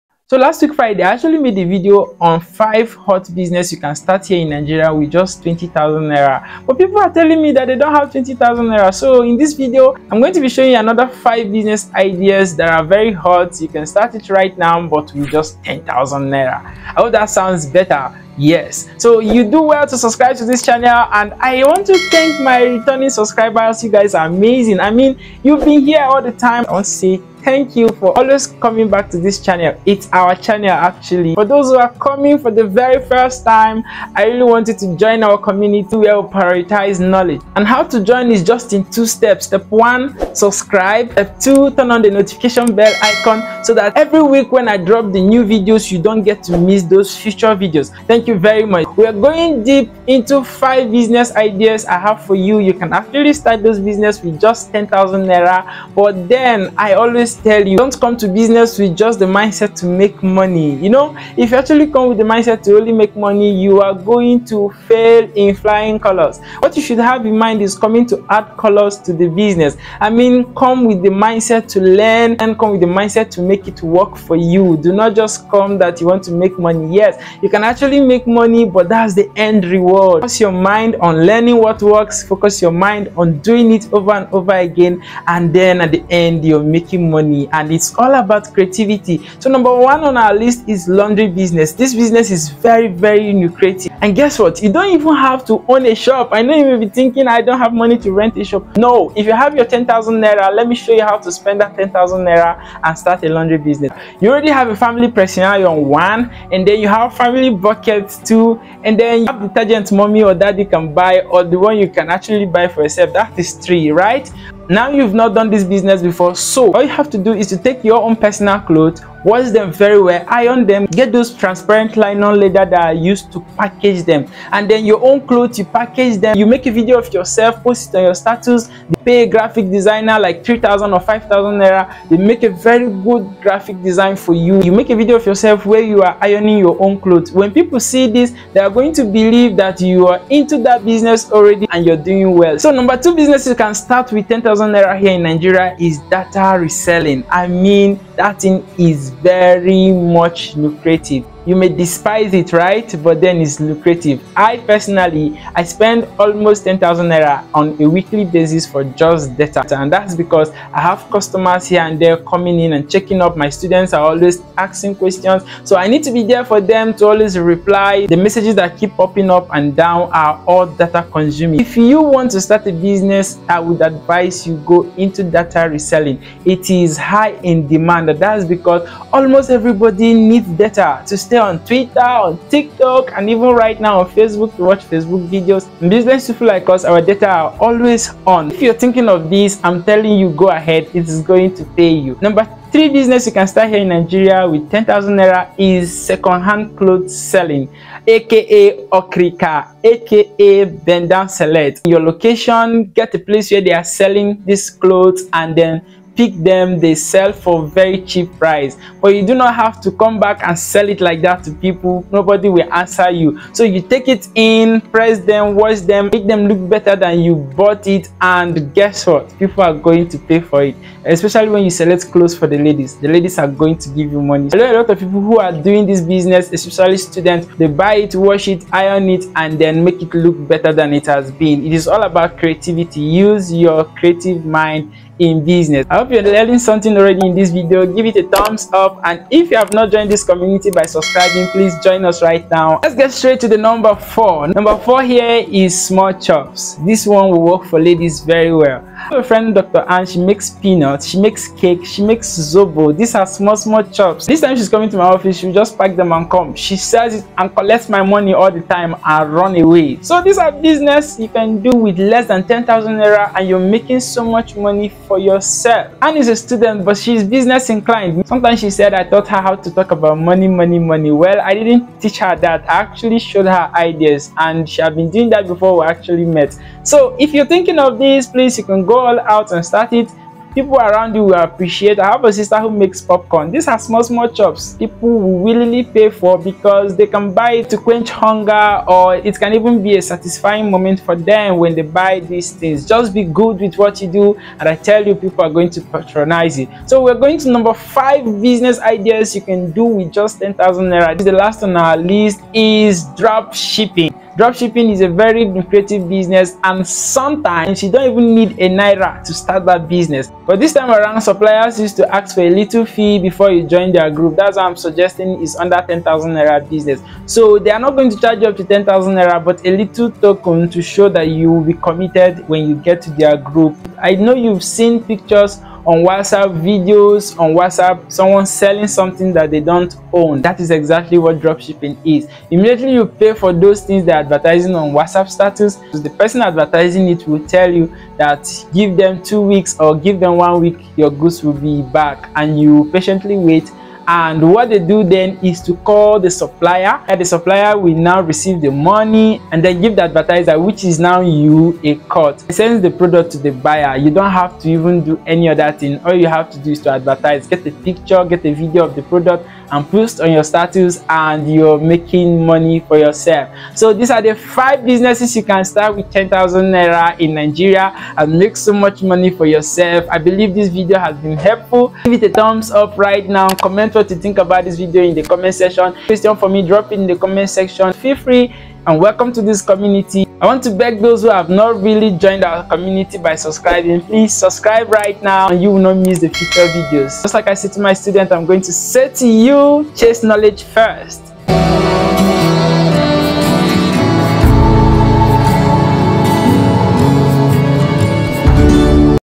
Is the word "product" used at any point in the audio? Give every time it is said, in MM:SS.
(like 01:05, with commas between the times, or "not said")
05:52, 05:59.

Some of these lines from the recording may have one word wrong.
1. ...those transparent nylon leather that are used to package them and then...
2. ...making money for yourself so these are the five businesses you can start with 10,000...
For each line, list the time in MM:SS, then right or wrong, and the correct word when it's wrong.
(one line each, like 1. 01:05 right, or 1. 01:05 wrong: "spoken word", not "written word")
1. 02:01 right
2. 06:01 right.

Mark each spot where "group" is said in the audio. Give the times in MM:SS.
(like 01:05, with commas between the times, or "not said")
05:14, 05:23.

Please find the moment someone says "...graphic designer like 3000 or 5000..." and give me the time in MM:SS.
02:09.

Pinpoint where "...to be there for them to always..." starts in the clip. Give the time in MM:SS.
02:46.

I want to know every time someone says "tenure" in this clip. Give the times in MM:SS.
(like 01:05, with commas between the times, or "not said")
not said.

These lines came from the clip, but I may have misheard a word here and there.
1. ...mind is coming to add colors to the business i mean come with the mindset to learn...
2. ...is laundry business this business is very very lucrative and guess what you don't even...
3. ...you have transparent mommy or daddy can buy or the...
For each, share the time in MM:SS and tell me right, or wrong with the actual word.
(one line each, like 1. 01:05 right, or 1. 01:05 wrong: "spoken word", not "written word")
1. 01:07 right
2. 01:30 right
3. 01:49 wrong: "detergent", not "transparent".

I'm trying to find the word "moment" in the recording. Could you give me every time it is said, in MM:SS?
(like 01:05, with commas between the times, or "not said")
04:50.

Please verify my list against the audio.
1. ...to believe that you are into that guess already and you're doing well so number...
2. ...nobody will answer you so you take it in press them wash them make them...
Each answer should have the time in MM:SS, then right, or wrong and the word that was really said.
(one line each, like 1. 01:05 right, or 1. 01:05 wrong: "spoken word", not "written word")
1. 02:18 wrong: "business", not "guess"
2. 03:32 right.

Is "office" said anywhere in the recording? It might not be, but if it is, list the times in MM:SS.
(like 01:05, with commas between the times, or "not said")
04:15.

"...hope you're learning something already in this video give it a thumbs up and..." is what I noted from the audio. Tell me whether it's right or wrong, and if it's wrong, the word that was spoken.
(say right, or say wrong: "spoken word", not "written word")
right.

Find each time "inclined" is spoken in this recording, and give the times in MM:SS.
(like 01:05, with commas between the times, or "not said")
04:27.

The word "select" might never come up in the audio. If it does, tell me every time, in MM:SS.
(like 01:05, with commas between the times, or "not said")
03:21, 03:41.